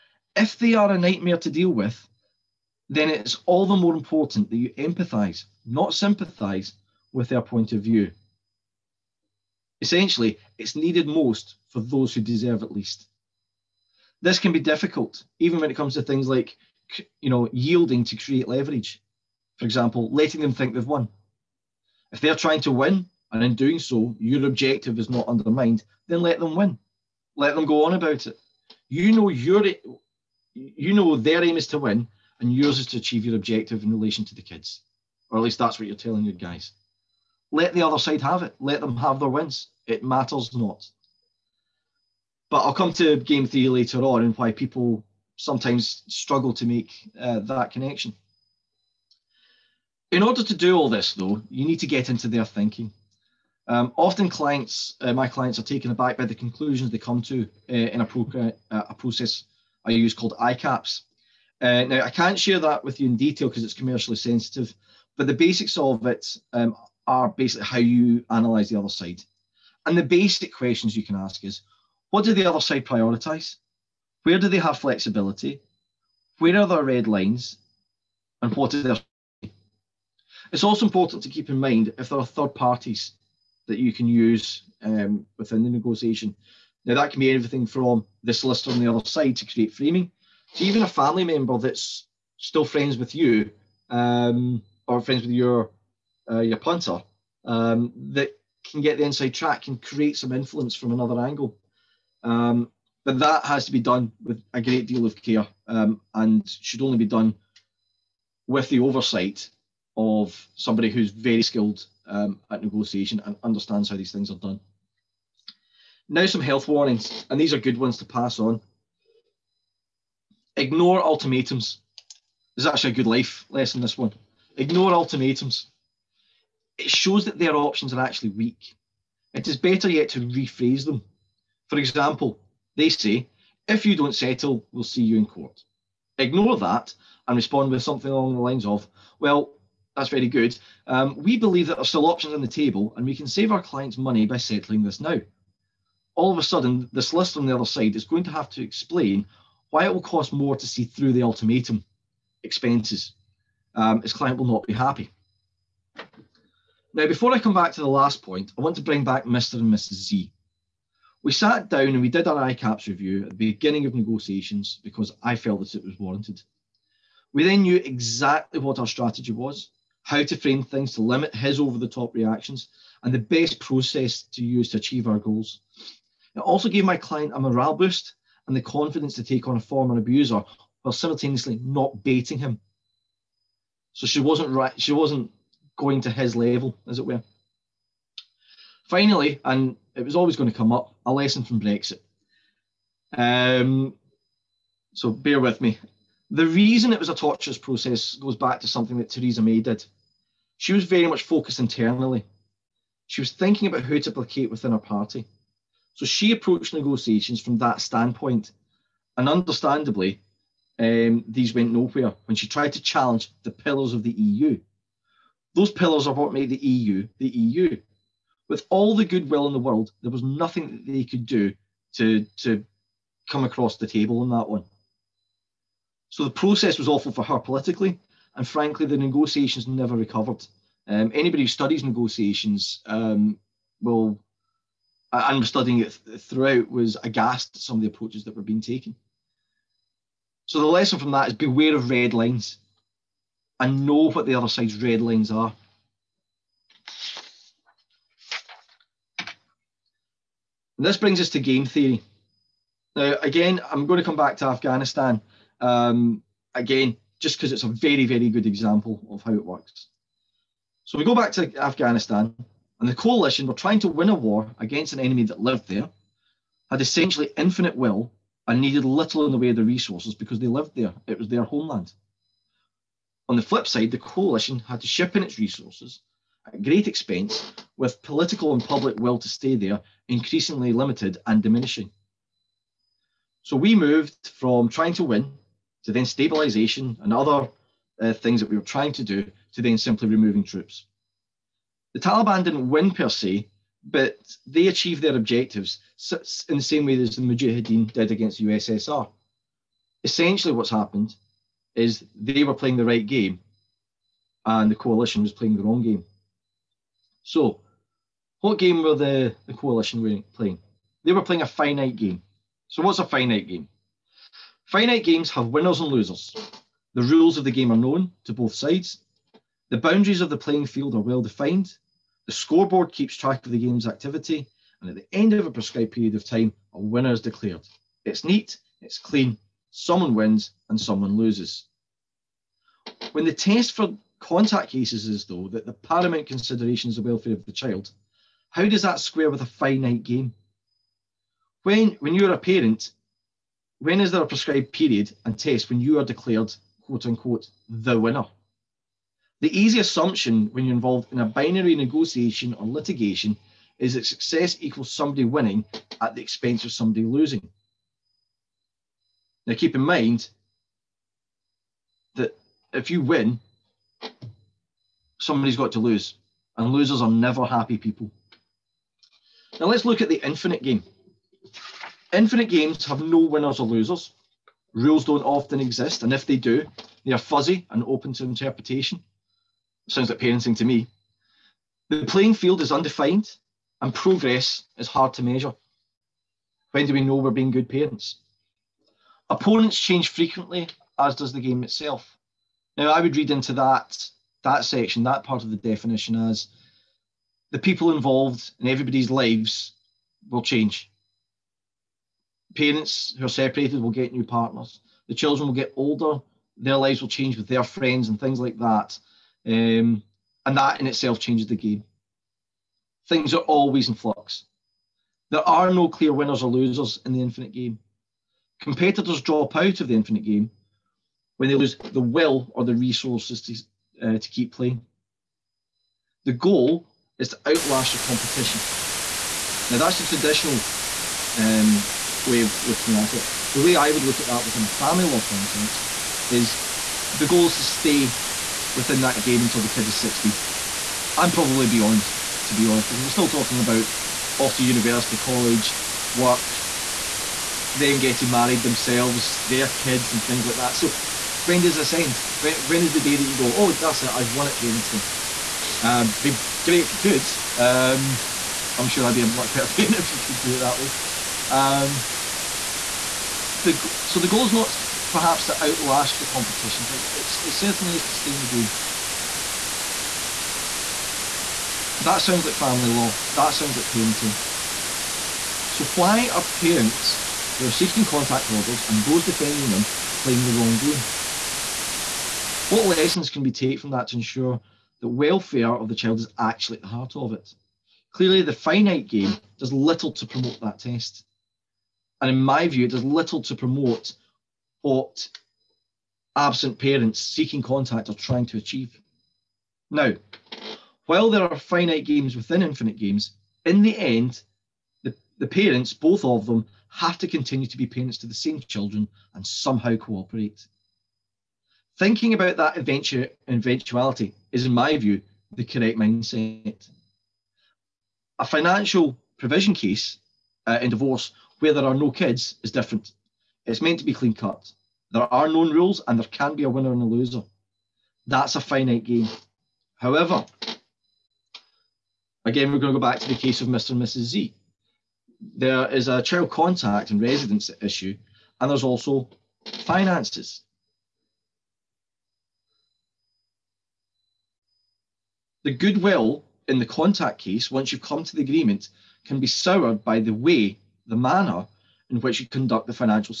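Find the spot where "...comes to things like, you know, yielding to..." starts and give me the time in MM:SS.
00:15.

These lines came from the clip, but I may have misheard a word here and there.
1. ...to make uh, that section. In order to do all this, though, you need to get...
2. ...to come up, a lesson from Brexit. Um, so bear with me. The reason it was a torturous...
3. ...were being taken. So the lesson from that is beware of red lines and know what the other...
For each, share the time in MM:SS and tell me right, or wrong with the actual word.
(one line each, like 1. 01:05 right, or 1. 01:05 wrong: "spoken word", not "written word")
1. 00:46 wrong: "connection", not "section"
2. 03:10 right
3. 03:58 right.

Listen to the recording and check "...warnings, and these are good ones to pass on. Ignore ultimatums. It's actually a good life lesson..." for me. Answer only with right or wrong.
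right.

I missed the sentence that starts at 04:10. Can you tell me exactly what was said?
And this brings us to game theory.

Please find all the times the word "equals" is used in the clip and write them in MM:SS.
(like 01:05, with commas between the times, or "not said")
05:54.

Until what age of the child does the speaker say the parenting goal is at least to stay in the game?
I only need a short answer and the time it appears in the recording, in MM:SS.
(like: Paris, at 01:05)
16, at 07:19.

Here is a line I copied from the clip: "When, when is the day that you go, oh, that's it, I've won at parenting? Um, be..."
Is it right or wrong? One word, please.
right.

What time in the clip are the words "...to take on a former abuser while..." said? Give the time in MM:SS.
02:59.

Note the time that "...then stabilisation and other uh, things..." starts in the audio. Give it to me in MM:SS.
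04:45.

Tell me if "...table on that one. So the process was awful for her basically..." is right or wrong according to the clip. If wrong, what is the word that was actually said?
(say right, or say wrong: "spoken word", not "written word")
wrong: "politically", not "basically".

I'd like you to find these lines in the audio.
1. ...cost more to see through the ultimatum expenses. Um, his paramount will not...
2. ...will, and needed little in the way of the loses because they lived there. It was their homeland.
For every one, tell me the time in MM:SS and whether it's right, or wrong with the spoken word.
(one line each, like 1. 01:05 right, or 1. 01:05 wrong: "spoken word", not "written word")
1. 02:30 wrong: "client", not "paramount"
2. 04:27 wrong: "resources", not "loses".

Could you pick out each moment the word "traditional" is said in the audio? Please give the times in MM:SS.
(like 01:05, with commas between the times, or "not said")
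07:10.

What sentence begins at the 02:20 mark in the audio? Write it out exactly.
Um, we believe that there are still options on the table and we can save our clients money by settling this now.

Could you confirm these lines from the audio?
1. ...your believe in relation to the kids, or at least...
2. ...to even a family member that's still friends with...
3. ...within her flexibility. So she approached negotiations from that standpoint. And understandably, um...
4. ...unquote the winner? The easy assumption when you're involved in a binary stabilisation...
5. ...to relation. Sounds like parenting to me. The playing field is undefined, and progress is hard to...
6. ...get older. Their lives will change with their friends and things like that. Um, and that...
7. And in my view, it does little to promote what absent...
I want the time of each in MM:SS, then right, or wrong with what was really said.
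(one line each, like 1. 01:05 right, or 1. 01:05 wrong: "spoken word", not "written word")
1. 00:33 wrong: "objective", not "believe"
2. 01:30 right
3. 03:24 wrong: "party", not "flexibility"
4. 05:47 wrong: "negotiation", not "stabilisation"
5. 06:18 wrong: "interpretation", not "relation"
6. 06:45 right
7. 08:12 right.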